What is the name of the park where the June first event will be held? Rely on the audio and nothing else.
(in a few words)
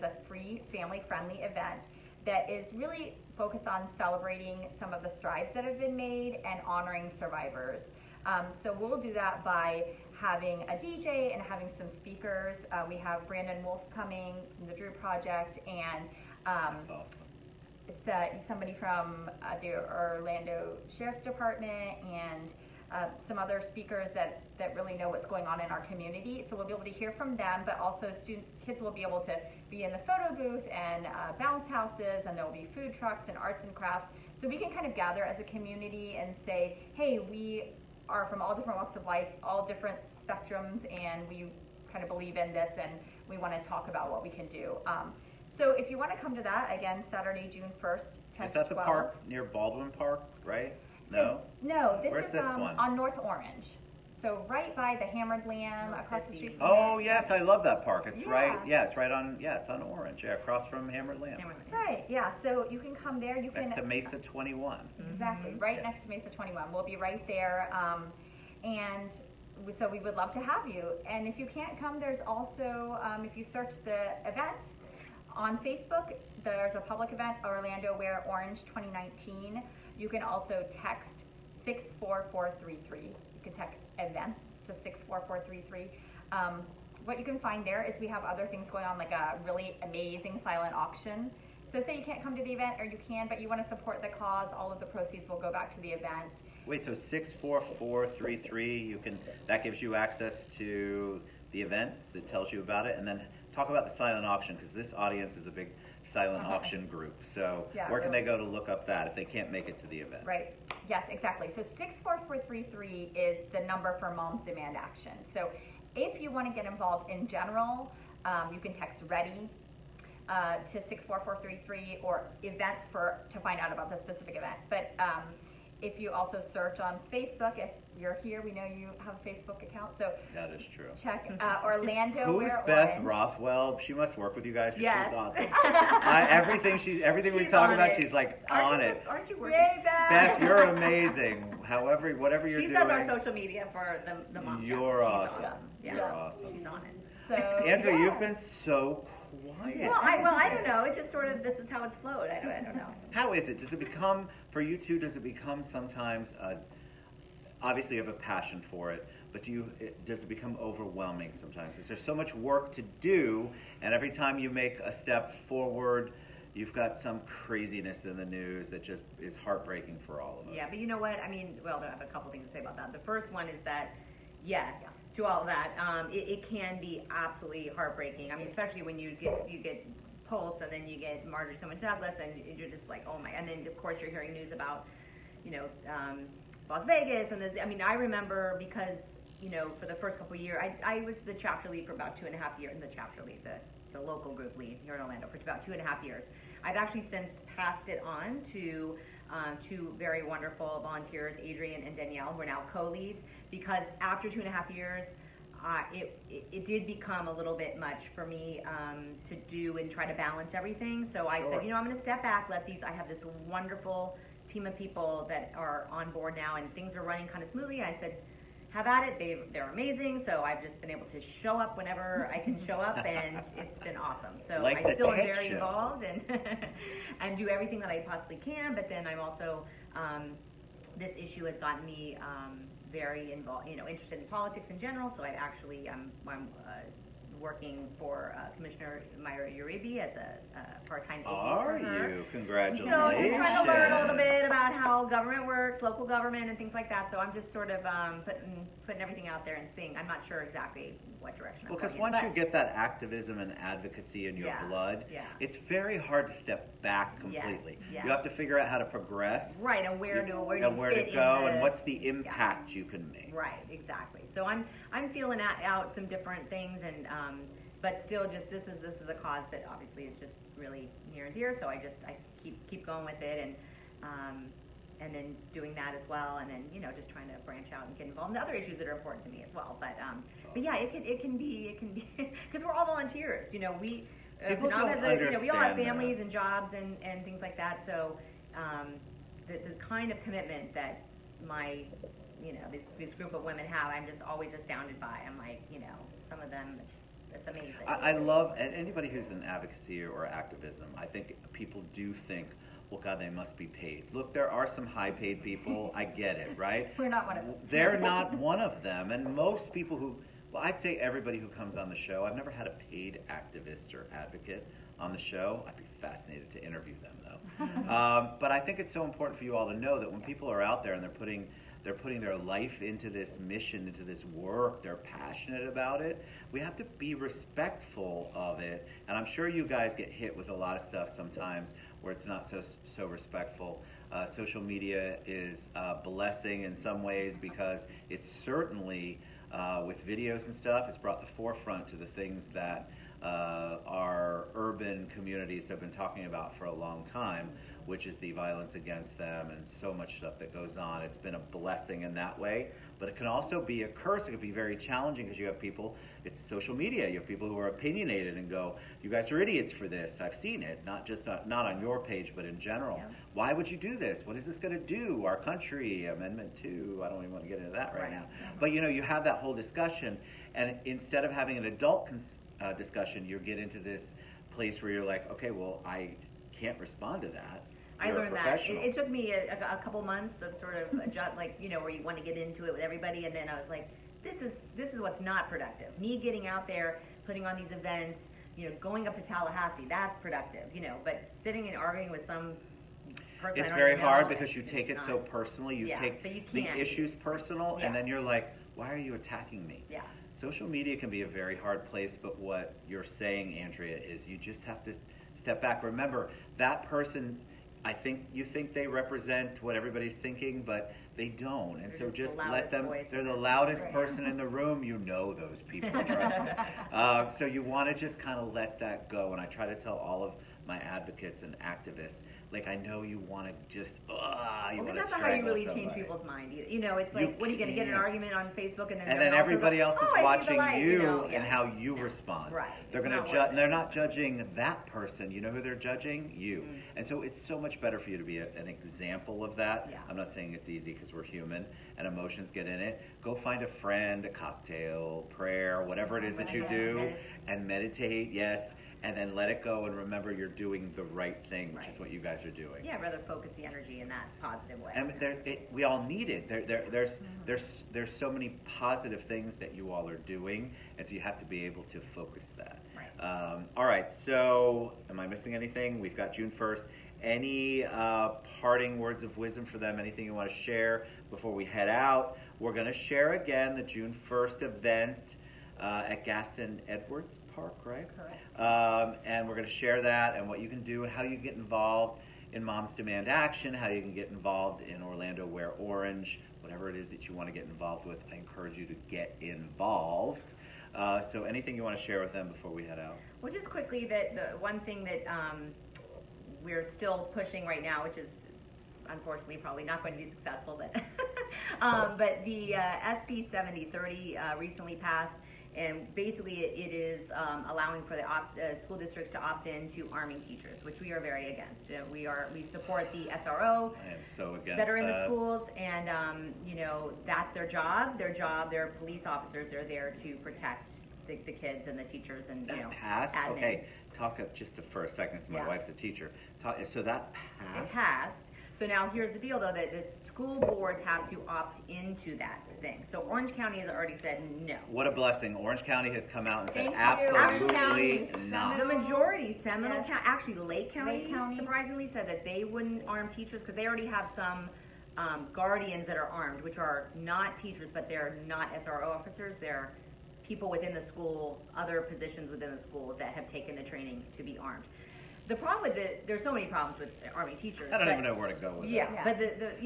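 Gaston Edwards Park.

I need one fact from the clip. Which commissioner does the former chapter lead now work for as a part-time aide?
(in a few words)
Mayra Uribe.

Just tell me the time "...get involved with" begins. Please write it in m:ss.
8:07.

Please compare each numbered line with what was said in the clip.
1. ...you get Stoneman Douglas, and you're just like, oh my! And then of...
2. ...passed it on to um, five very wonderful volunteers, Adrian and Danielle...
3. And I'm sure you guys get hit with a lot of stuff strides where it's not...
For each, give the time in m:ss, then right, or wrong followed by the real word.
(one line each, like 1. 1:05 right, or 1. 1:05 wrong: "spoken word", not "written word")
1. 3:00 right
2. 3:17 wrong: "two", not "five"
3. 5:29 wrong: "sometimes", not "strides".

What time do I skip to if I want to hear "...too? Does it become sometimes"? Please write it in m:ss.
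2:34.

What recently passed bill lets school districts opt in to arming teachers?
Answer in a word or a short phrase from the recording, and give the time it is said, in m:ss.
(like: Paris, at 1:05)
SB 7030, at 8:23.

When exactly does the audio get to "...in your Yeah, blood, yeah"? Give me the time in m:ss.
4:14.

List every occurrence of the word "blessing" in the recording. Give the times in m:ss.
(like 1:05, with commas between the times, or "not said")
5:36, 5:51, 8:55.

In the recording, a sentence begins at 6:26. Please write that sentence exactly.
Me getting out there, putting on these events, you know, going up to Tallahassee, that's productive, you know.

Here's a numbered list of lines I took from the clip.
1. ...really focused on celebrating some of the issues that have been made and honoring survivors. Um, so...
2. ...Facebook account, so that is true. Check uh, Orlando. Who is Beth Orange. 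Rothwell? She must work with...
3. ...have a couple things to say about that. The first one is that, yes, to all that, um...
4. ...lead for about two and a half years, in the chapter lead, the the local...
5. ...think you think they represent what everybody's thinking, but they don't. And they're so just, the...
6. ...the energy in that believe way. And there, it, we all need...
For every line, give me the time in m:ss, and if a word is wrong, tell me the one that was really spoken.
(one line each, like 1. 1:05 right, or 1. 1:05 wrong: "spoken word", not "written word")
1. 0:02 wrong: "strides", not "issues"
2. 2:09 right
3. 2:51 right
4. 3:11 right
5. 6:47 right
6. 7:33 wrong: "positive", not "believe".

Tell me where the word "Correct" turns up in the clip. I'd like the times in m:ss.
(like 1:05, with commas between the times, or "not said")
7:58.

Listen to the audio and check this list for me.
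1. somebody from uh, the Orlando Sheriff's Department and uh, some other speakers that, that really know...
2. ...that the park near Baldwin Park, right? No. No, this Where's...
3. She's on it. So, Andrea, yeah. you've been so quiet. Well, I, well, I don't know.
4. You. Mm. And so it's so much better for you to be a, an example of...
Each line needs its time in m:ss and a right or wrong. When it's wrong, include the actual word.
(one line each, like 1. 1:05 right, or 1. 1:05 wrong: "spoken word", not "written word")
1. 0:18 right
2. 0:48 right
3. 2:26 right
4. 7:16 right.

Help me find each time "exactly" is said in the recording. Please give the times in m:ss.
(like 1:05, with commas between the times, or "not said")
1:05, 1:51, 4:10, 4:23.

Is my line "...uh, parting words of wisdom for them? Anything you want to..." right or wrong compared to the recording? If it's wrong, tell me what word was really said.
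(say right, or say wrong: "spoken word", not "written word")
right.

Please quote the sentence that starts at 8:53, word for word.
So Orange County has already said no.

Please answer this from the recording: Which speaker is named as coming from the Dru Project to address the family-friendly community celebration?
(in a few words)
Brandon Wolf.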